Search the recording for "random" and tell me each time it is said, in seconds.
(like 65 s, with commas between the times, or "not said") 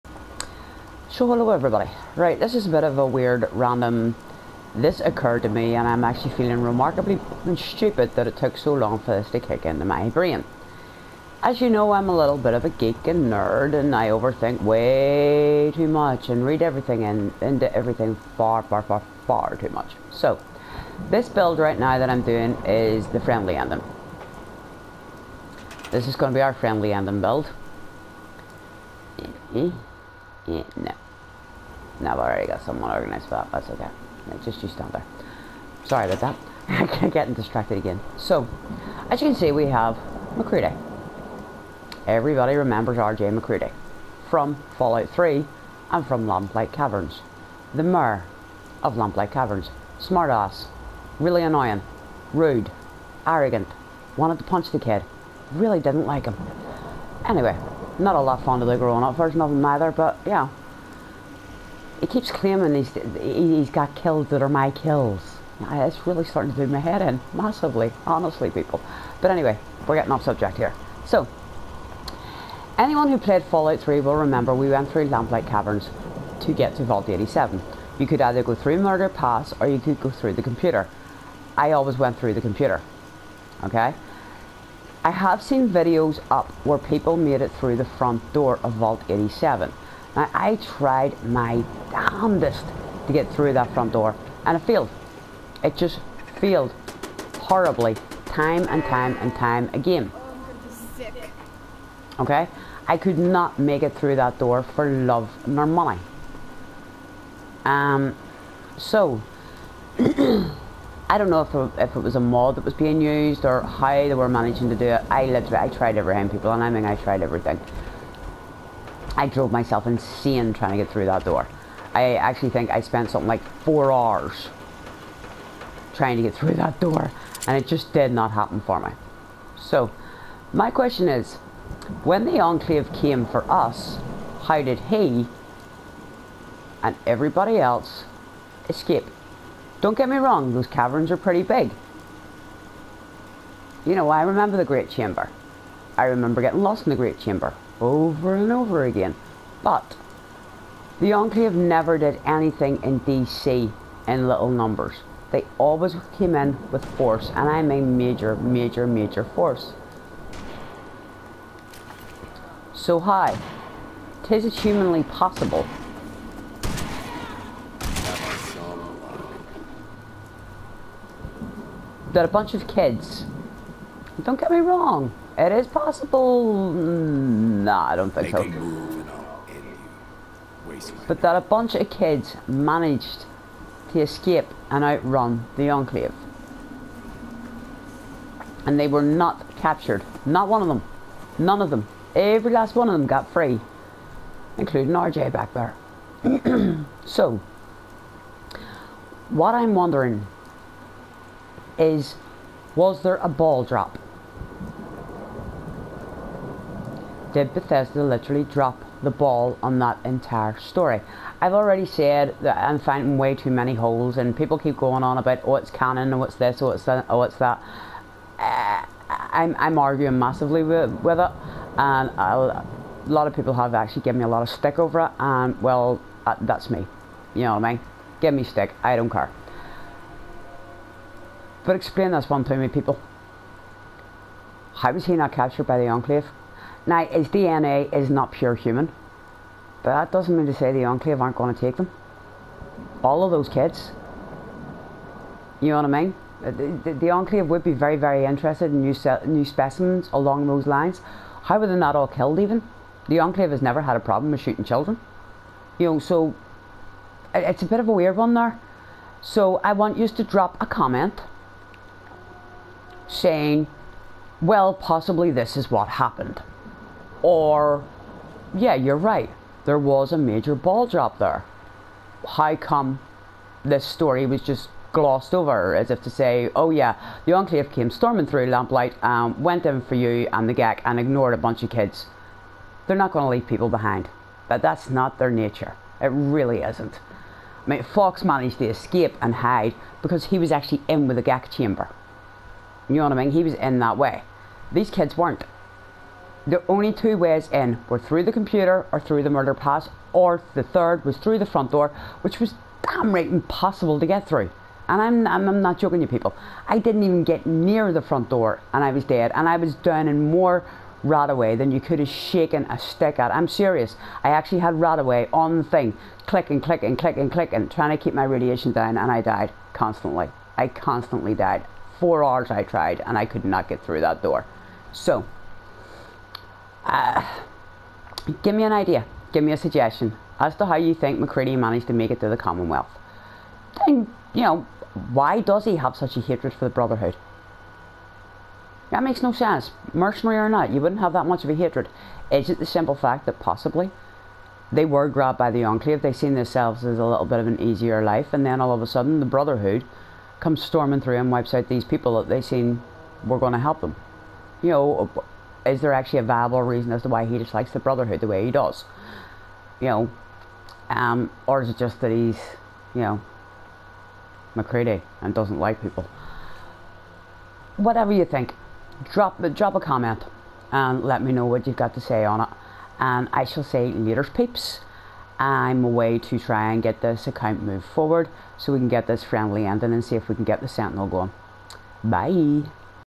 3 s.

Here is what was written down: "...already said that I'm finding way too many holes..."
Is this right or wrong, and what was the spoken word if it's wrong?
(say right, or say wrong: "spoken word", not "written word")
right.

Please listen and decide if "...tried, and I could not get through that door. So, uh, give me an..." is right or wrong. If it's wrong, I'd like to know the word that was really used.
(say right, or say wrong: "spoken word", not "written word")
right.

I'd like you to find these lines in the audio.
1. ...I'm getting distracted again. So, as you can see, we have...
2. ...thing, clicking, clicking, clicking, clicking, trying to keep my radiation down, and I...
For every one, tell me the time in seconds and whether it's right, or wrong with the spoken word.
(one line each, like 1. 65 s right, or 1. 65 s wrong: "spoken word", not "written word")
1. 37 s right
2. 315 s right.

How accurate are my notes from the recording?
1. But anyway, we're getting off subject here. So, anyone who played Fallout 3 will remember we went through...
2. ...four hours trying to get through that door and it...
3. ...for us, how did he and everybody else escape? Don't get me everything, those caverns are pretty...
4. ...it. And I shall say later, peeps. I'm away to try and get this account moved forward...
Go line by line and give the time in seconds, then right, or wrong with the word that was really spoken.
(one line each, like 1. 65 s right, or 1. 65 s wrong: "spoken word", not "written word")
1. 69 s right
2. 123 s right
3. 133 s wrong: "wrong", not "everything"
4. 372 s right.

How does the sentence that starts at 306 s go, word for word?
I didn't even get near the front door and I was dead.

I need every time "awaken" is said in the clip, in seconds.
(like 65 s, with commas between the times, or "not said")
not said.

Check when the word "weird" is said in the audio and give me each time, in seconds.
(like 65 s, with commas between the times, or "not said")
3 s, 257 s.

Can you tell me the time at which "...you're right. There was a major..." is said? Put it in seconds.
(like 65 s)
268 s.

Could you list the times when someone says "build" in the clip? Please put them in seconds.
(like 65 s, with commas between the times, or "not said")
21 s, 27 s.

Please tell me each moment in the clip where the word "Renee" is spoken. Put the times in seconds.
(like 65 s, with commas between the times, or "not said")
not said.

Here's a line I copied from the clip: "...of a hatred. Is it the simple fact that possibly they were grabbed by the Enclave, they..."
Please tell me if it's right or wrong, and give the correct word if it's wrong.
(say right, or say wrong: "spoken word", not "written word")
right.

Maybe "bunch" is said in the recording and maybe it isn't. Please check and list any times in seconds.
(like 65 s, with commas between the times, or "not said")
172 s, 181 s, 281 s.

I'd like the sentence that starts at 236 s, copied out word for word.
Now, his DNA is not pure human, but that doesn't mean to say the Enclave aren't going to take them.